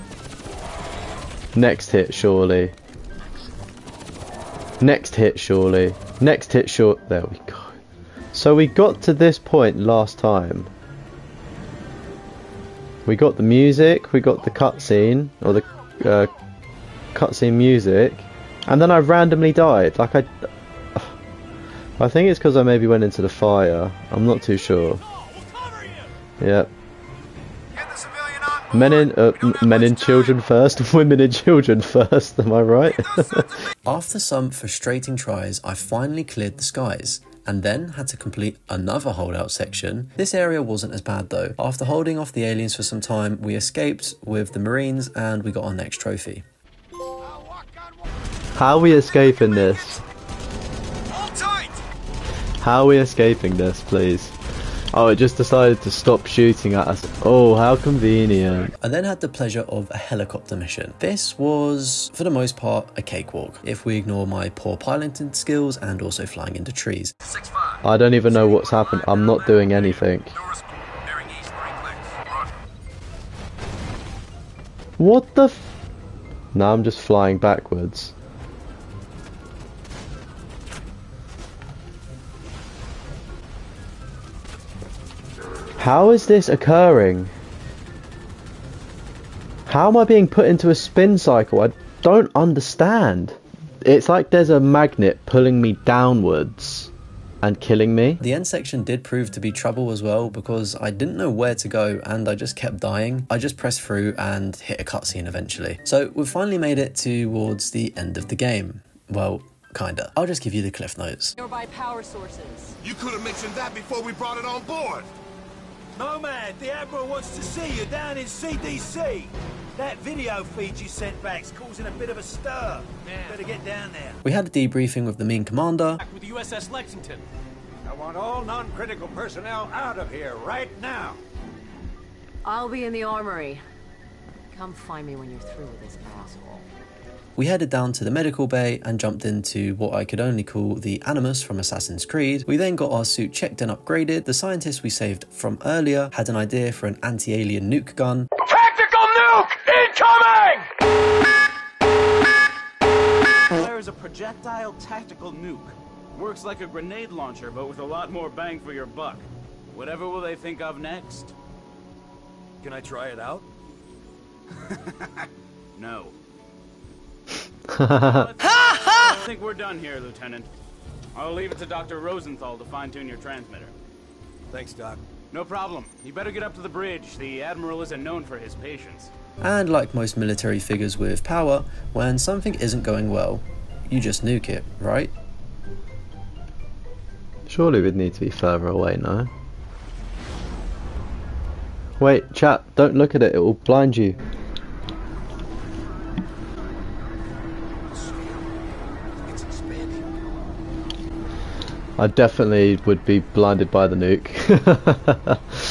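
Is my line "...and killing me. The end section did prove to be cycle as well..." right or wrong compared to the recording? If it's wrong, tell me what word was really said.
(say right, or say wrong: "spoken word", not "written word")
wrong: "trouble", not "cycle".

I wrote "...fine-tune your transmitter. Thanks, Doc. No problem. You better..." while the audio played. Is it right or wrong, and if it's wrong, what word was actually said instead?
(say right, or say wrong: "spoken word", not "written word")
right.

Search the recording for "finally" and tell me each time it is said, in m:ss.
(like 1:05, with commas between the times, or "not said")
0:35, 1:46.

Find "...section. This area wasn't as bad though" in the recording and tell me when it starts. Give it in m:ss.
0:39.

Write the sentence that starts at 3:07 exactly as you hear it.
Surely we'd need to be further away now.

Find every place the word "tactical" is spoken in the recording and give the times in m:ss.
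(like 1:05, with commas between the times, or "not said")
2:28, 2:34.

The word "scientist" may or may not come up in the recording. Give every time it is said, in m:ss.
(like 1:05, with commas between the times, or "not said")
2:24.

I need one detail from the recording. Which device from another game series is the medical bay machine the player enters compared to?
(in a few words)
The Animus.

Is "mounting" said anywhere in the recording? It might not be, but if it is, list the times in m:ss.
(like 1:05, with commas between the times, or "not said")
not said.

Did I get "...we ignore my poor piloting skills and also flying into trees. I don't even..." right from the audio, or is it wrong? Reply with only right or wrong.
right.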